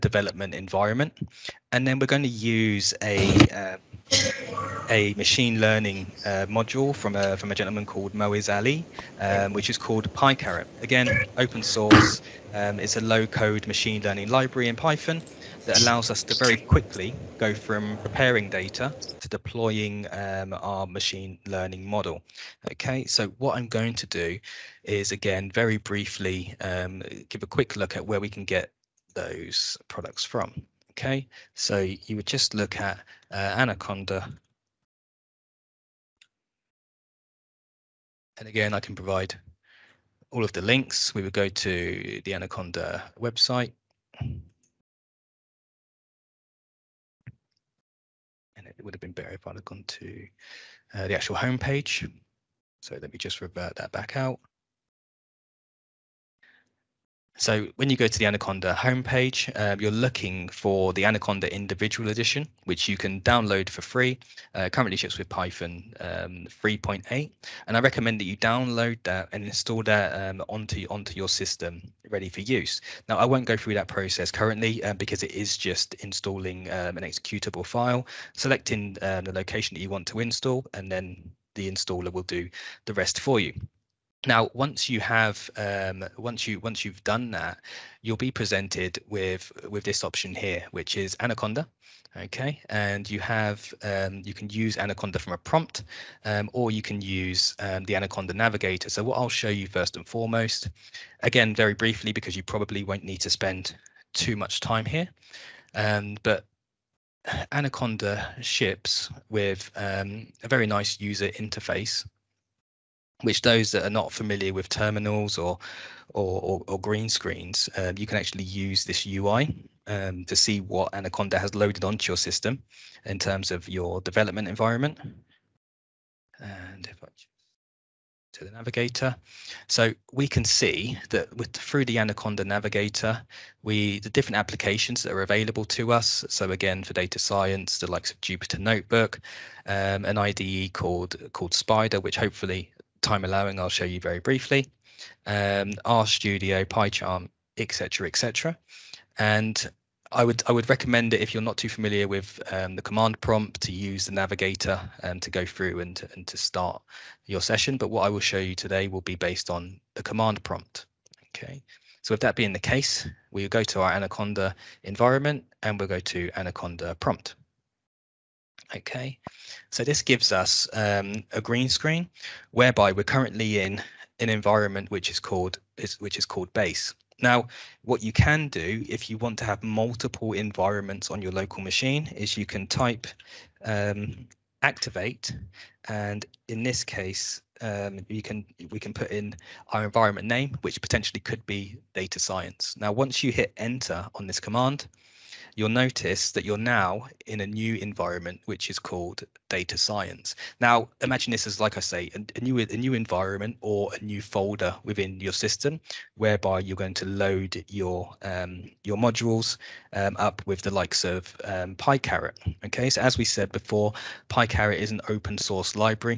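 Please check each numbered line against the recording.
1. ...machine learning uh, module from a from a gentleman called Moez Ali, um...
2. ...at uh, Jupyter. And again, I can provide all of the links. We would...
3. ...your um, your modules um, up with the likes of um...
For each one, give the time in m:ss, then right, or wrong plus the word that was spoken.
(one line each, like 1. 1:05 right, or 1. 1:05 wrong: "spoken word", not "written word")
1. 0:05 right
2. 0:32 wrong: "Anaconda", not "Jupyter"
3. 3:27 right.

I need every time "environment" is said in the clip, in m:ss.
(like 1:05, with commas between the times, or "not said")
0:00, 2:04, 2:44, 2:54, 3:00, 3:09, 3:17, 3:22.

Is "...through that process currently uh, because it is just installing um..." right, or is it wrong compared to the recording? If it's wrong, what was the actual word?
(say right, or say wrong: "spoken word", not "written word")
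right.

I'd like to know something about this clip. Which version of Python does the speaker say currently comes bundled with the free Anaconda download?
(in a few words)
3.8.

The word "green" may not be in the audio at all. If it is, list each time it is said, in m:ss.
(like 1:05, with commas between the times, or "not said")
1:56, 2:51.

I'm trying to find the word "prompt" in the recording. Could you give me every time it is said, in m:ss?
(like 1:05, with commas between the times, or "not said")
1:35, 2:33, 2:40, 2:46.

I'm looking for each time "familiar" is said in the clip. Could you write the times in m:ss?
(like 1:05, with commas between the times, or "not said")
1:54, 2:31.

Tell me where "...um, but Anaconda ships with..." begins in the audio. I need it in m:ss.
1:45.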